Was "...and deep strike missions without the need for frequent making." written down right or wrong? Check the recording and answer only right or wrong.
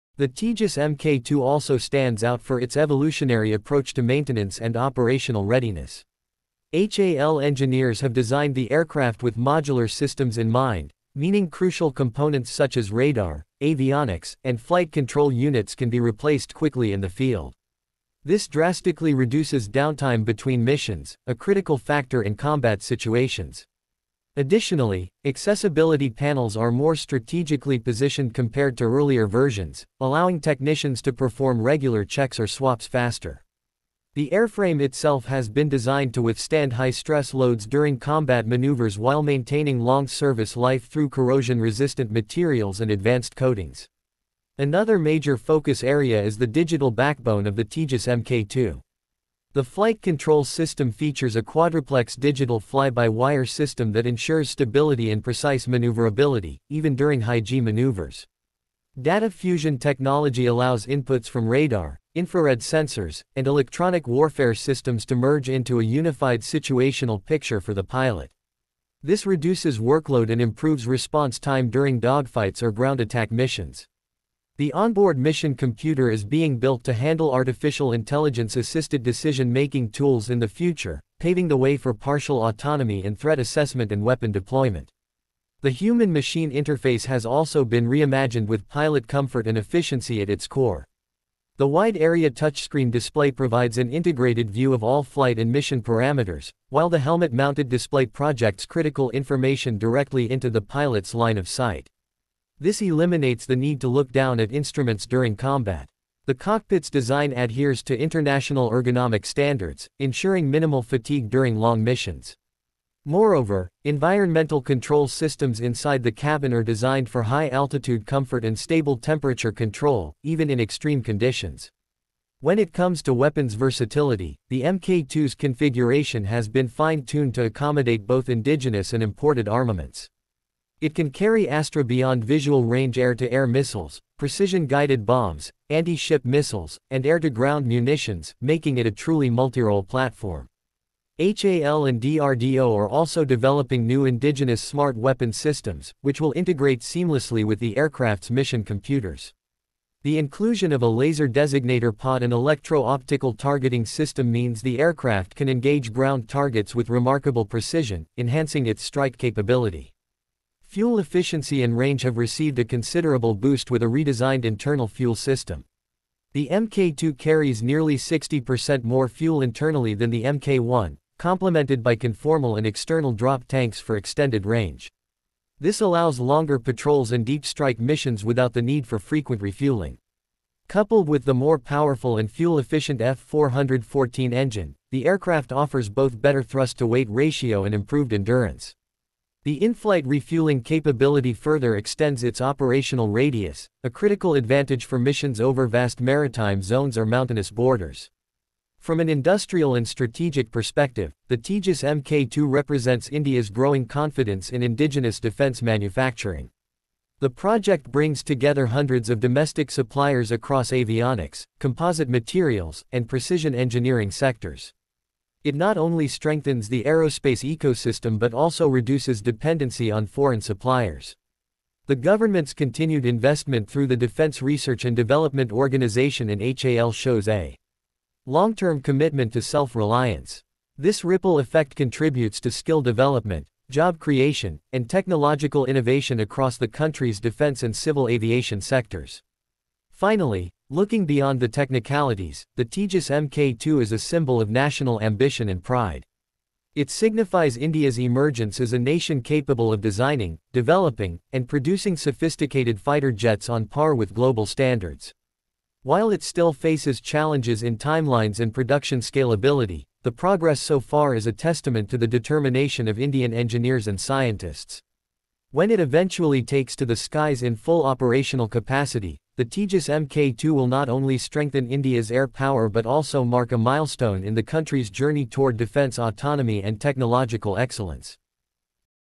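wrong.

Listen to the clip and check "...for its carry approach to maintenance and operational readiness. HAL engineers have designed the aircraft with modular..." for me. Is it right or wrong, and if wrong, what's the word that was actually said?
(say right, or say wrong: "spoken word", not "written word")
wrong: "evolutionary", not "carry".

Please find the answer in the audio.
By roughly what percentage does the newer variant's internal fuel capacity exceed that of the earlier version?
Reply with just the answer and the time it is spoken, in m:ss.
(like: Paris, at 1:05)
60%, at 2:47.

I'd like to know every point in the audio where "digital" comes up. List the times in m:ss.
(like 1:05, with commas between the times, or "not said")
0:46, 0:52.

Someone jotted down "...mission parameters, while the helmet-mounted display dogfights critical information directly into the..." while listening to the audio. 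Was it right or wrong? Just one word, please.
wrong.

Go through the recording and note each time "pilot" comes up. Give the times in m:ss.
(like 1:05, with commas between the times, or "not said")
1:07, 1:28, 1:40.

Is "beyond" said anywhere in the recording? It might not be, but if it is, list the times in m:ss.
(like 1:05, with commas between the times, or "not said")
2:11, 4:01.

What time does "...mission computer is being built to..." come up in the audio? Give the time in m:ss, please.
1:15.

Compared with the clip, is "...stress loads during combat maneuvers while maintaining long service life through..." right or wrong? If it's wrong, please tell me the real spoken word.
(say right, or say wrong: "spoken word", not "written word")
right.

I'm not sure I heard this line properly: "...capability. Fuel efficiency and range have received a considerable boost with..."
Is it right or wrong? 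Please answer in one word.
right.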